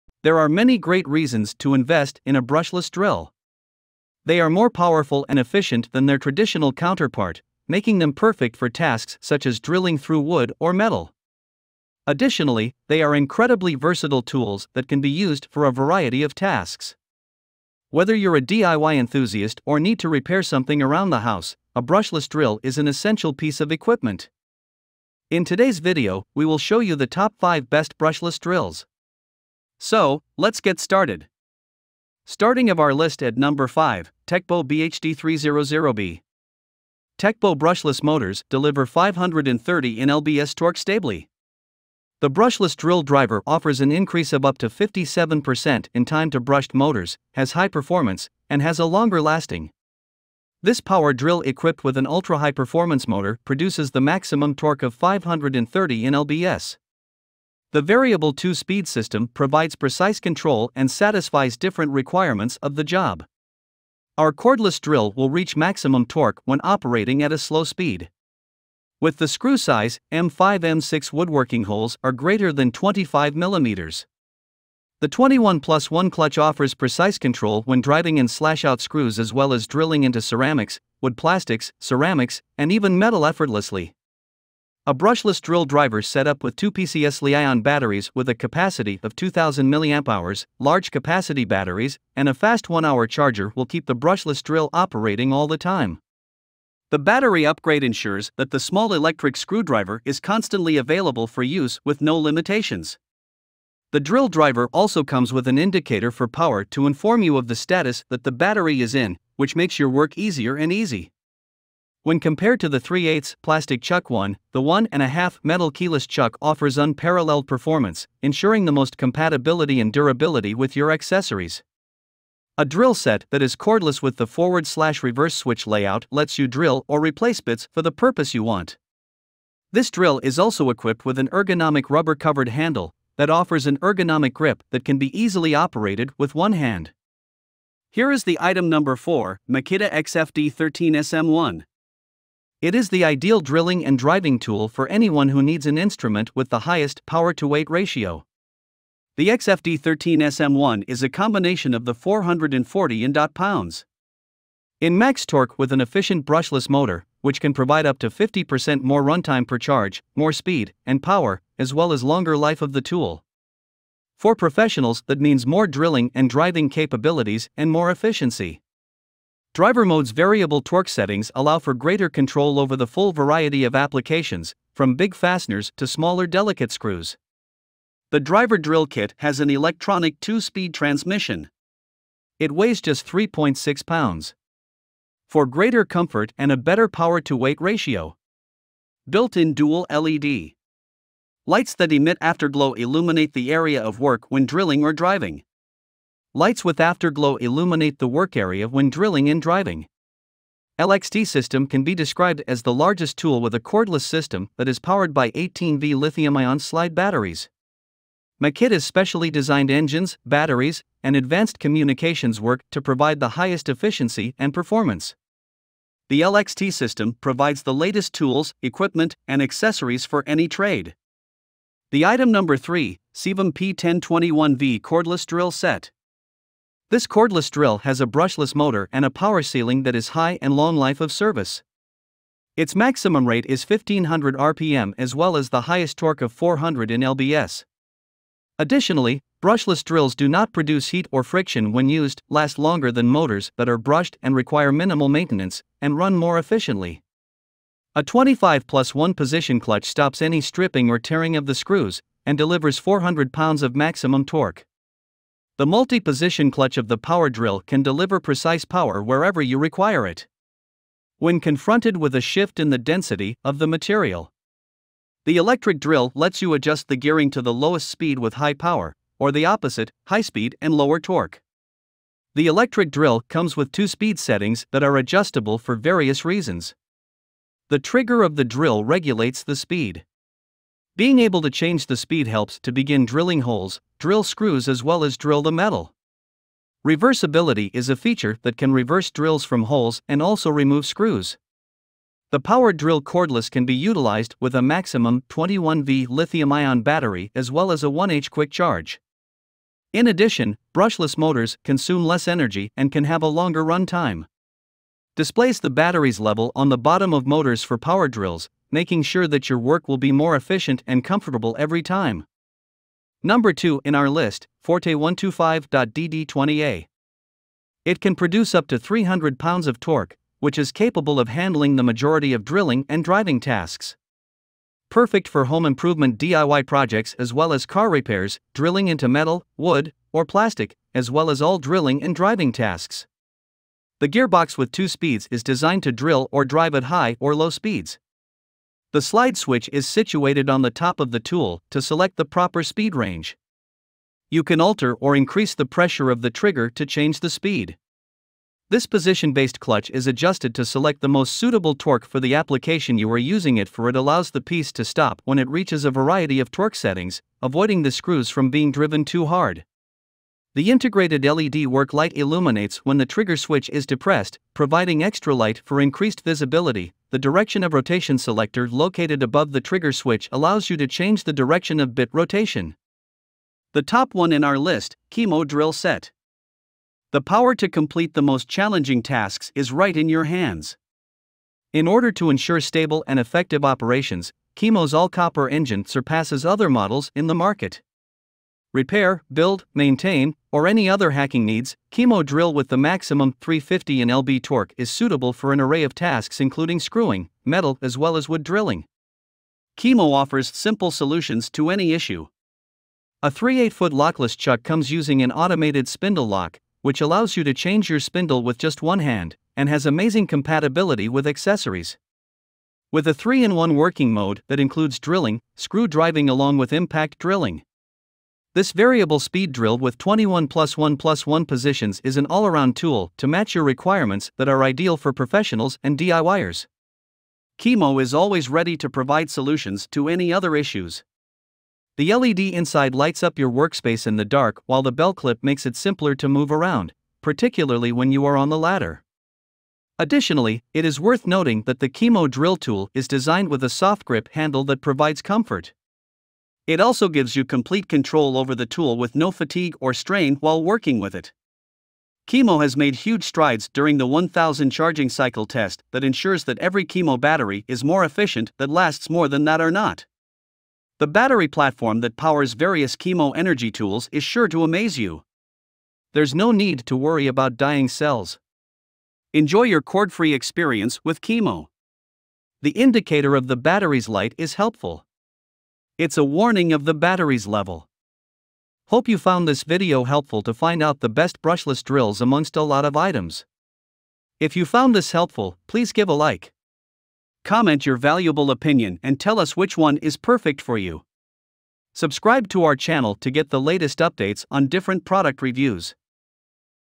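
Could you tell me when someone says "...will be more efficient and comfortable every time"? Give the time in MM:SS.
05:09.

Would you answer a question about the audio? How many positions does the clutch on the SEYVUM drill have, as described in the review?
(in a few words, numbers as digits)
25 plus 1.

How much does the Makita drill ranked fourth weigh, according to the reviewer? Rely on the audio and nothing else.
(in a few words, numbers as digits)
3.6 pounds.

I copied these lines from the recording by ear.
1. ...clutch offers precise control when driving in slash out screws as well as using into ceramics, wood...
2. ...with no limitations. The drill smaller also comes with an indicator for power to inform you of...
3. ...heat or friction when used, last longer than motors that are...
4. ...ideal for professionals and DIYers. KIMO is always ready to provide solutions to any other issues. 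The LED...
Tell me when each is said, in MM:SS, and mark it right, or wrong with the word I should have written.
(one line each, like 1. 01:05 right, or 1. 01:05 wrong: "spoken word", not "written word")
1. 01:16 wrong: "drilling", not "using"
2. 01:41 wrong: "driver", not "smaller"
3. 04:00 right
4. 07:04 right.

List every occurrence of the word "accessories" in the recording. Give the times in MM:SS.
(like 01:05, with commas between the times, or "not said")
02:00, 03:39, 06:51.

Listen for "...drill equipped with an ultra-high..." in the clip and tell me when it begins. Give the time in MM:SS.
00:51.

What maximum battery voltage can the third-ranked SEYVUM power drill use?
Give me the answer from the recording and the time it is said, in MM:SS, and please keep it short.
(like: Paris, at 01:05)
21V, at 04:55.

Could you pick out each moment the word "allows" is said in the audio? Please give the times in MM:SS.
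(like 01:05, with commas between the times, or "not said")
02:51, 05:53, 06:10, 06:47.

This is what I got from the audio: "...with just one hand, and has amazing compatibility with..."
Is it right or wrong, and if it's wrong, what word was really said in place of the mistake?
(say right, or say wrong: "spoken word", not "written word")
right.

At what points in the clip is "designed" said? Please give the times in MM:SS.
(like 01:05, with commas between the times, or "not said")
03:29, 05:35, 07:23.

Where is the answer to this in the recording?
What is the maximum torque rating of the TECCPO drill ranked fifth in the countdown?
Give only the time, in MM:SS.
00:38.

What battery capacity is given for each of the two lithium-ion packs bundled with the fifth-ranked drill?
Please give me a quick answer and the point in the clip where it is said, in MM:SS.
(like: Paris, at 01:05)
2000 mAh, at 01:29.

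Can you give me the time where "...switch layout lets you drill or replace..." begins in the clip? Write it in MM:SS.
02:05.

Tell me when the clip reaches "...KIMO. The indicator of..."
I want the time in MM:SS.
07:51.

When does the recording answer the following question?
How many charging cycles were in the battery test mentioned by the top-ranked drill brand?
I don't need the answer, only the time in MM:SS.
07:34.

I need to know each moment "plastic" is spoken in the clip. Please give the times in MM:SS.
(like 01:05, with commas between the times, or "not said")
01:21, 01:53, 05:30.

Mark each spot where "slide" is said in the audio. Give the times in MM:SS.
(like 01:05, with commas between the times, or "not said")
03:26, 05:39.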